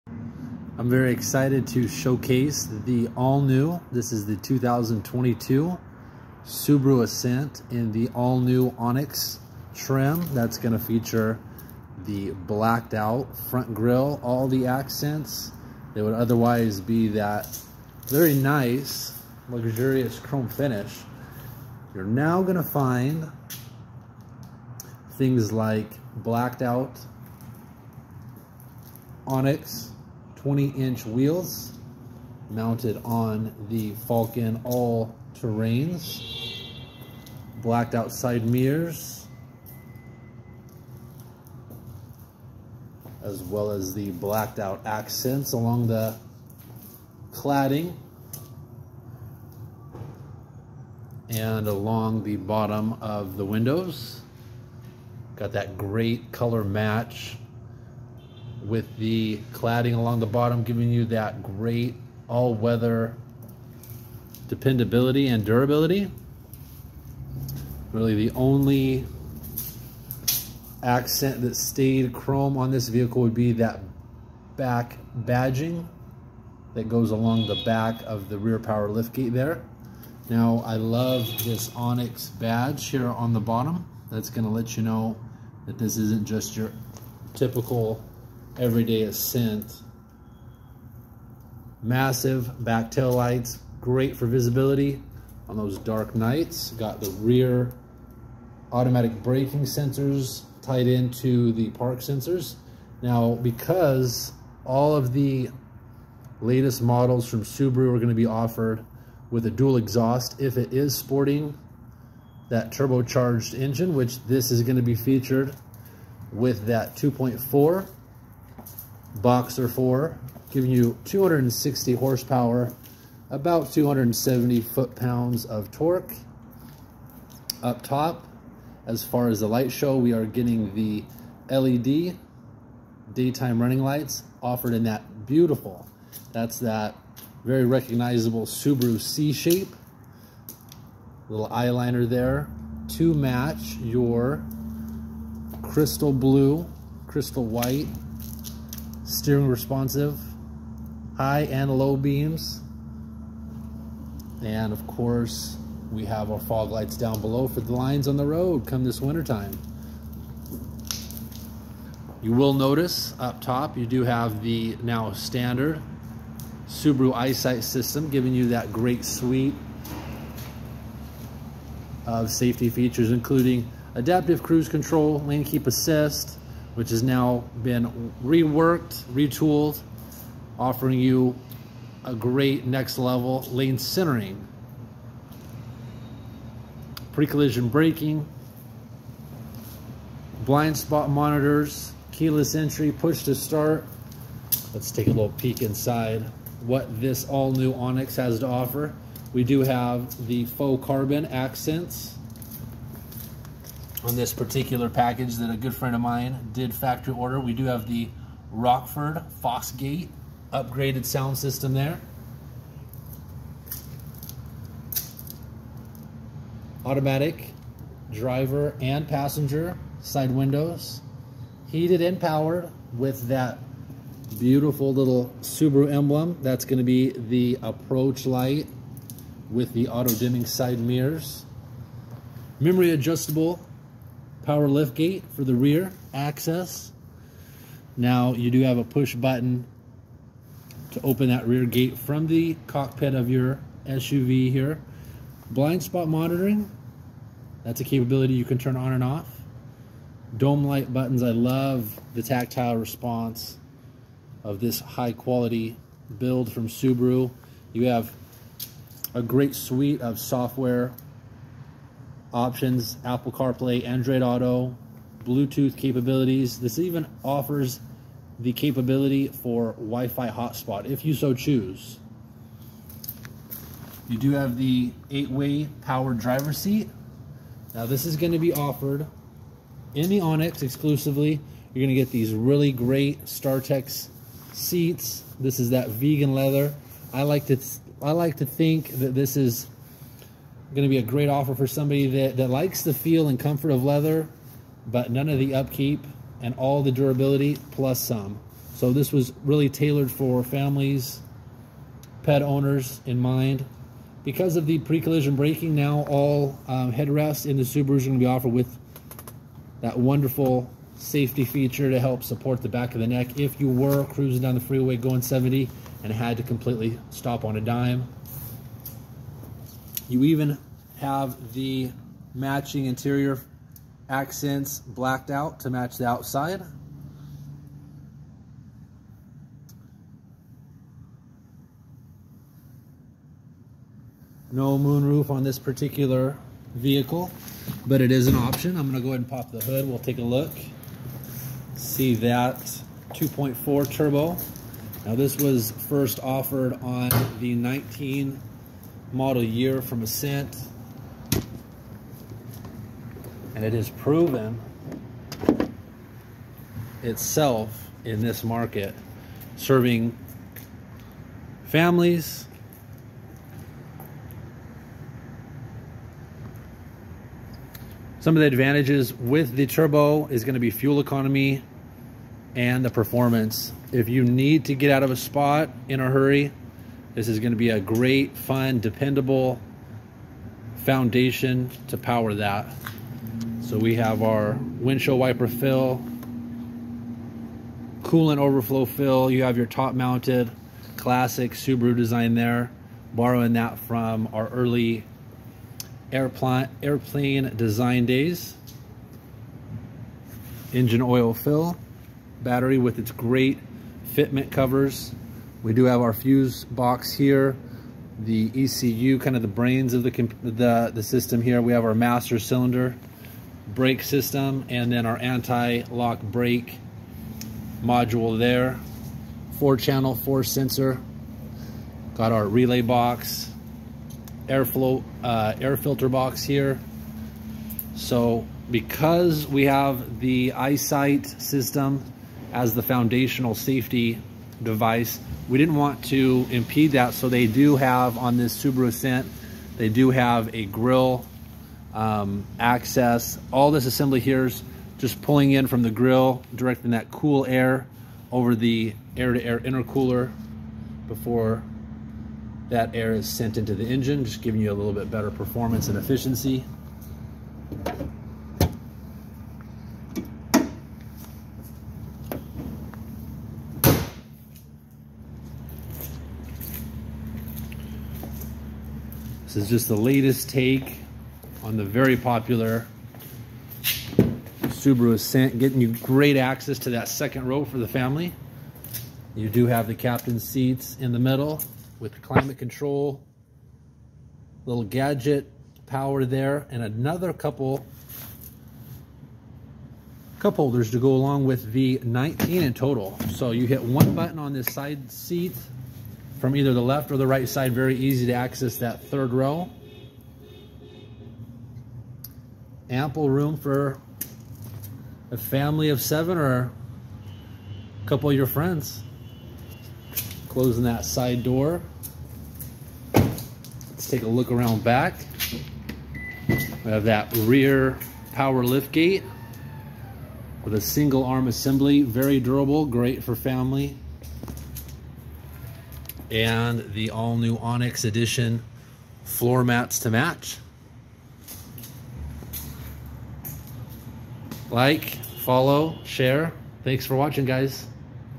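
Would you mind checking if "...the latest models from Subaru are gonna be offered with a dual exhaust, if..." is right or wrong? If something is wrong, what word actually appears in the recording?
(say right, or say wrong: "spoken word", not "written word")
right.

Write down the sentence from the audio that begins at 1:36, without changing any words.
Got the rear automatic braking sensors tied into the park sensors.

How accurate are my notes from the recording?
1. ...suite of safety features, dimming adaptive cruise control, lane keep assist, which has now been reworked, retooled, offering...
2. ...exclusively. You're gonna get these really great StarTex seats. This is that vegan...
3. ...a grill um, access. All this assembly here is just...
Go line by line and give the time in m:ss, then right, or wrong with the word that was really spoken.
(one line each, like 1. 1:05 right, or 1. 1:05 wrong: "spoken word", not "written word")
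1. 2:49 wrong: "including", not "dimming"
2. 4:40 right
3. 7:20 right.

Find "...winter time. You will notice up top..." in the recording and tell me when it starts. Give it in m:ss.
2:39.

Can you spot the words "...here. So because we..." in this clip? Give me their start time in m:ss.
7:06.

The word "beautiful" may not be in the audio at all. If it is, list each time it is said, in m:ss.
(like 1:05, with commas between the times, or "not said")
2:15, 3:44.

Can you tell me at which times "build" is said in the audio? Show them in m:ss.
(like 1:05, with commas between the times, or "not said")
4:16.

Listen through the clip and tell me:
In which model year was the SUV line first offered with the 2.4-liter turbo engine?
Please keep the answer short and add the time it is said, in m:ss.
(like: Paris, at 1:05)
2019, at 5:47.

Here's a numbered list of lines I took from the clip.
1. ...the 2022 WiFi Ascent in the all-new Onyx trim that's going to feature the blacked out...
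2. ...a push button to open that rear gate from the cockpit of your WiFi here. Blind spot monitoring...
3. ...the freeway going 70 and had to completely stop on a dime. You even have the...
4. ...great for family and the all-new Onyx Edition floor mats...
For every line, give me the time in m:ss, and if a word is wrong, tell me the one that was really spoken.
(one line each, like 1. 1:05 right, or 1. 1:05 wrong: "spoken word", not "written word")
1. 0:04 wrong: "Subaru", not "WiFi"
2. 3:58 wrong: "SUV", not "WiFi"
3. 5:14 right
4. 8:42 right.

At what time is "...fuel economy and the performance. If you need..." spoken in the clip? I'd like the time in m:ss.
6:10.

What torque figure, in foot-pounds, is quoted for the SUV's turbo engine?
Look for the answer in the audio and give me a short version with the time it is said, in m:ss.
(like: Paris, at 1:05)
270, at 2:03.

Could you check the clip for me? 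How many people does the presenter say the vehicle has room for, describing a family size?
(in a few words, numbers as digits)
7.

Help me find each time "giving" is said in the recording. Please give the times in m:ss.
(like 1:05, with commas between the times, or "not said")
1:00, 2:00, 2:48, 7:34.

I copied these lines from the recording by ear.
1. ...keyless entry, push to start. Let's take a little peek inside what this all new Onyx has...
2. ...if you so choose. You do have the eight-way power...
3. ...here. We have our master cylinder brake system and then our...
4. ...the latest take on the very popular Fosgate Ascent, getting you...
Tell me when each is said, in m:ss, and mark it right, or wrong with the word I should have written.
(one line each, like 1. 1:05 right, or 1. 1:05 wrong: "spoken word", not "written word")
1. 3:12 right
2. 4:30 right
3. 6:51 right
4. 7:49 wrong: "Subaru", not "Fosgate".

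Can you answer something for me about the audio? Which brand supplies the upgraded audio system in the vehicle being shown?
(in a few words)
Rockford Fosgate.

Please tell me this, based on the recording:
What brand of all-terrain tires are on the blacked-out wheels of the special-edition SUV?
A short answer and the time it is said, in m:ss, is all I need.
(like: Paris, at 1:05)
Falken, at 0:33.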